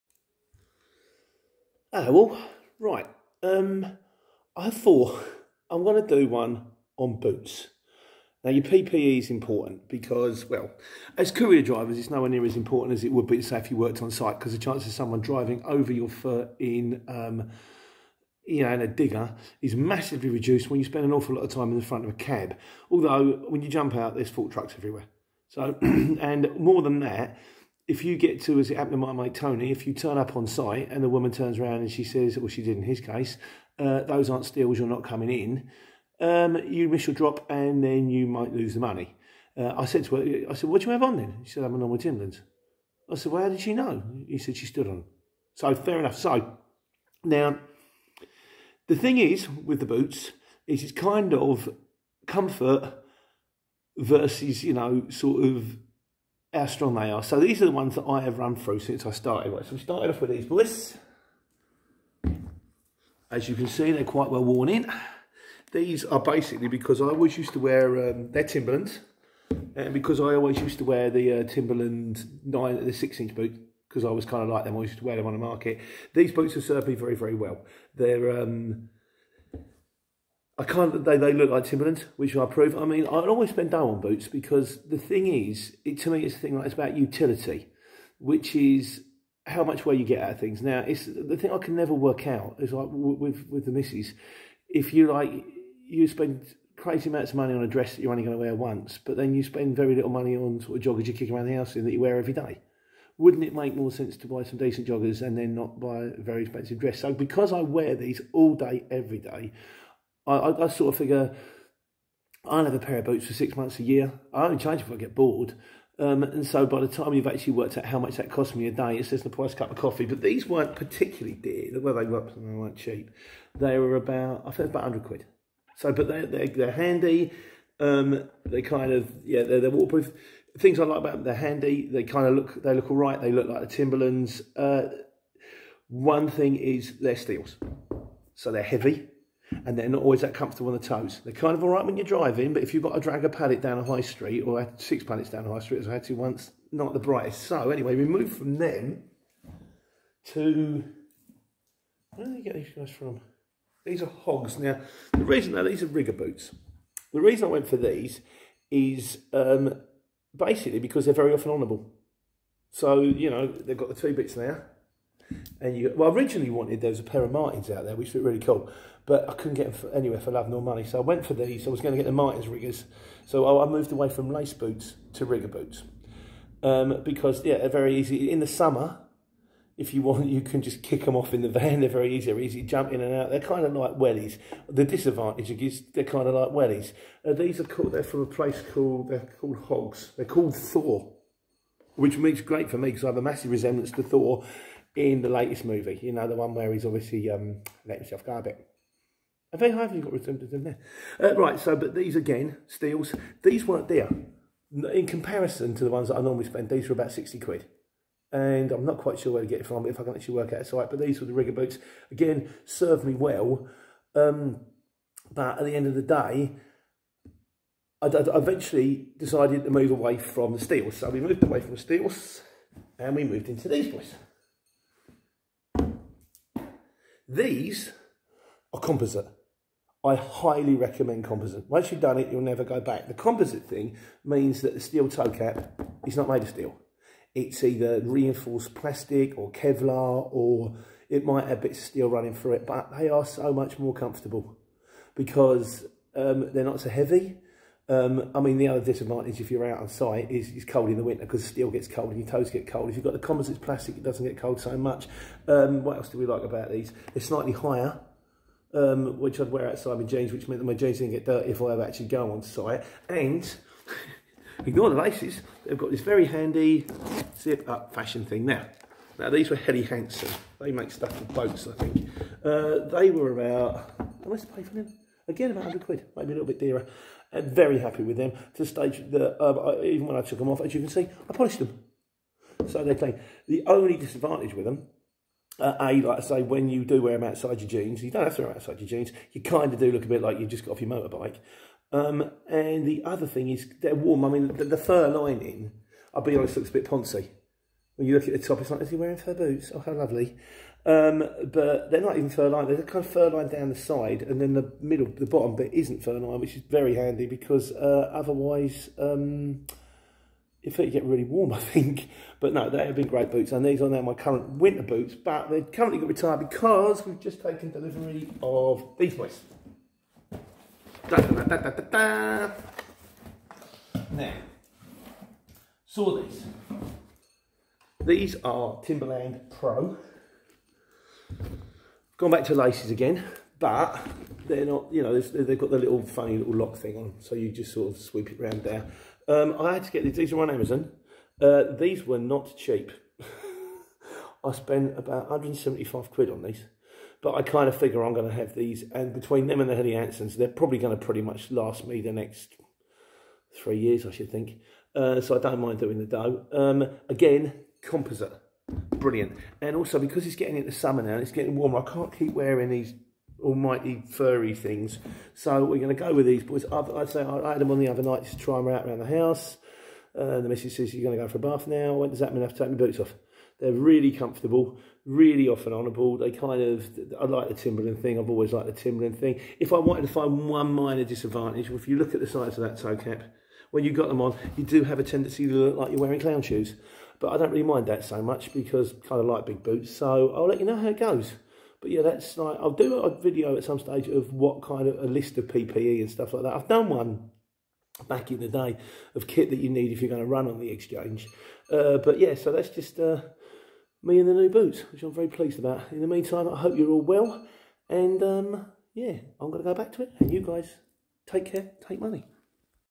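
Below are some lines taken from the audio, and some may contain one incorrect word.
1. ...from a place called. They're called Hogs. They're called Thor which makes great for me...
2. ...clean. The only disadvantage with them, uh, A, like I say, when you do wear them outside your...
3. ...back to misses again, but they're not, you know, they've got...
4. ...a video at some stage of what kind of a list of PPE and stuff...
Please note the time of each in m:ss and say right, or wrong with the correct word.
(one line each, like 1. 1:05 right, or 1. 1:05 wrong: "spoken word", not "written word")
1. 3:08 right
2. 4:42 right
3. 5:32 wrong: "laces", not "misses"
4. 6:32 right.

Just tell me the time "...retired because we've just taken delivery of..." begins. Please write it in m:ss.
5:16.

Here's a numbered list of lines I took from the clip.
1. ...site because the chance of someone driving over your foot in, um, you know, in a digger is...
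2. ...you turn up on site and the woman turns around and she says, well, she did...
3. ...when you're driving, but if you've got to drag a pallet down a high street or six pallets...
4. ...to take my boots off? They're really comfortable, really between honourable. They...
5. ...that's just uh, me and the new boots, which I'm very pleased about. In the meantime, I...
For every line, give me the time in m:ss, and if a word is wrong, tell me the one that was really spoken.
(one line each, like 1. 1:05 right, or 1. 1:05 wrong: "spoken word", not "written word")
1. 0:14 right
2. 0:29 right
3. 2:21 right
4. 6:12 wrong: "often", not "between"
5. 6:42 right.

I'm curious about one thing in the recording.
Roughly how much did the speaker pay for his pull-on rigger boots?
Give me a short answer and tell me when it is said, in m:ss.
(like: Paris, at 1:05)
60 quid, at 3:27.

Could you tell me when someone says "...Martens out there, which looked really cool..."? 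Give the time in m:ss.
2:47.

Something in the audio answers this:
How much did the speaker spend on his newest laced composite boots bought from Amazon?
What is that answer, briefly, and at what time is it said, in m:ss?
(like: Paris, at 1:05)
175 quid, at 5:45.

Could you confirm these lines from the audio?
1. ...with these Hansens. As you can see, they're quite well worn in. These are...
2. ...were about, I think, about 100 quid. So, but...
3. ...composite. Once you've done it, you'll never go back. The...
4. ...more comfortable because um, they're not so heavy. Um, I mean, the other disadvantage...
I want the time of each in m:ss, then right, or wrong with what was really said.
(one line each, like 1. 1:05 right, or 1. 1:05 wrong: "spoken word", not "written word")
1. 1:00 wrong: "Bliss", not "Hansens"
2. 2:03 right
3. 3:51 right
4. 4:03 right.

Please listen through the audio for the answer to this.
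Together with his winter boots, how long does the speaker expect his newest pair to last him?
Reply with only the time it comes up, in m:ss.
5:53.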